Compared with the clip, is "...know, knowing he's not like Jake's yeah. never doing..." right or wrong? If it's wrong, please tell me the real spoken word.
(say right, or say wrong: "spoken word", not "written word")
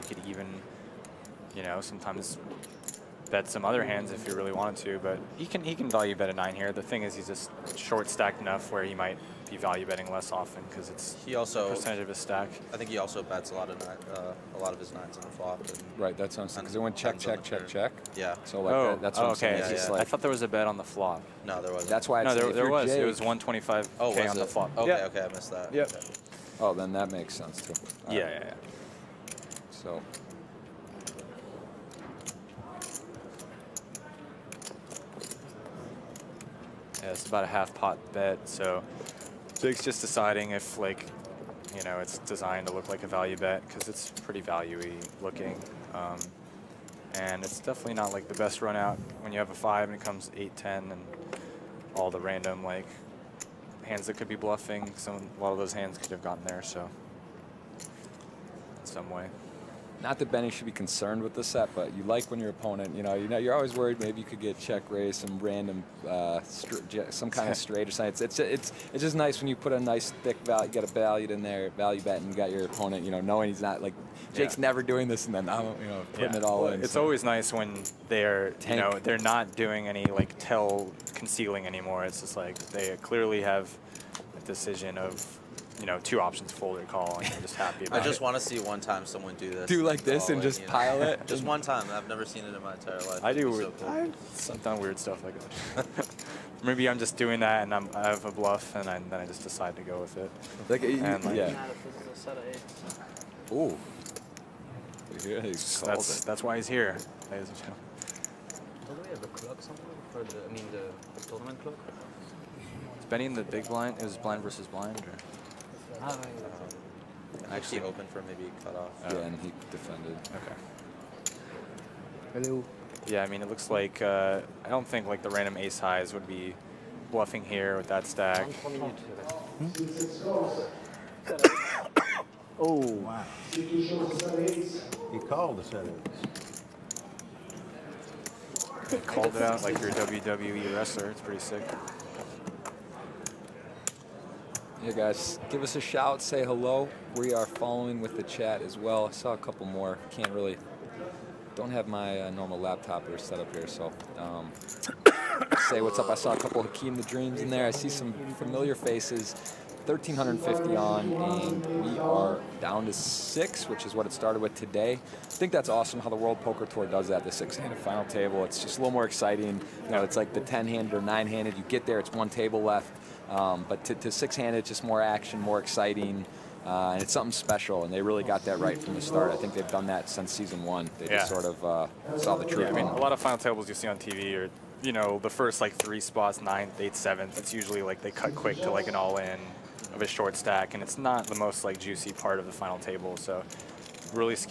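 right.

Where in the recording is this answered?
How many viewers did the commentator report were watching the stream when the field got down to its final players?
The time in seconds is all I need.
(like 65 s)
159 s.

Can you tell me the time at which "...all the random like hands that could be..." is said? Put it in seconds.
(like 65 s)
51 s.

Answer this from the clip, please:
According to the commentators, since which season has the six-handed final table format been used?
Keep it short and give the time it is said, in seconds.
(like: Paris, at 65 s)
Season one, at 180 s.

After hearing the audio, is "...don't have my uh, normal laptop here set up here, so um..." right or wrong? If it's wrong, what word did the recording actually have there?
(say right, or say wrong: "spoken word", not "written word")
right.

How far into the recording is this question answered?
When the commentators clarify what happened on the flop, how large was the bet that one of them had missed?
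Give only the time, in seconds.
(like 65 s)
23 s.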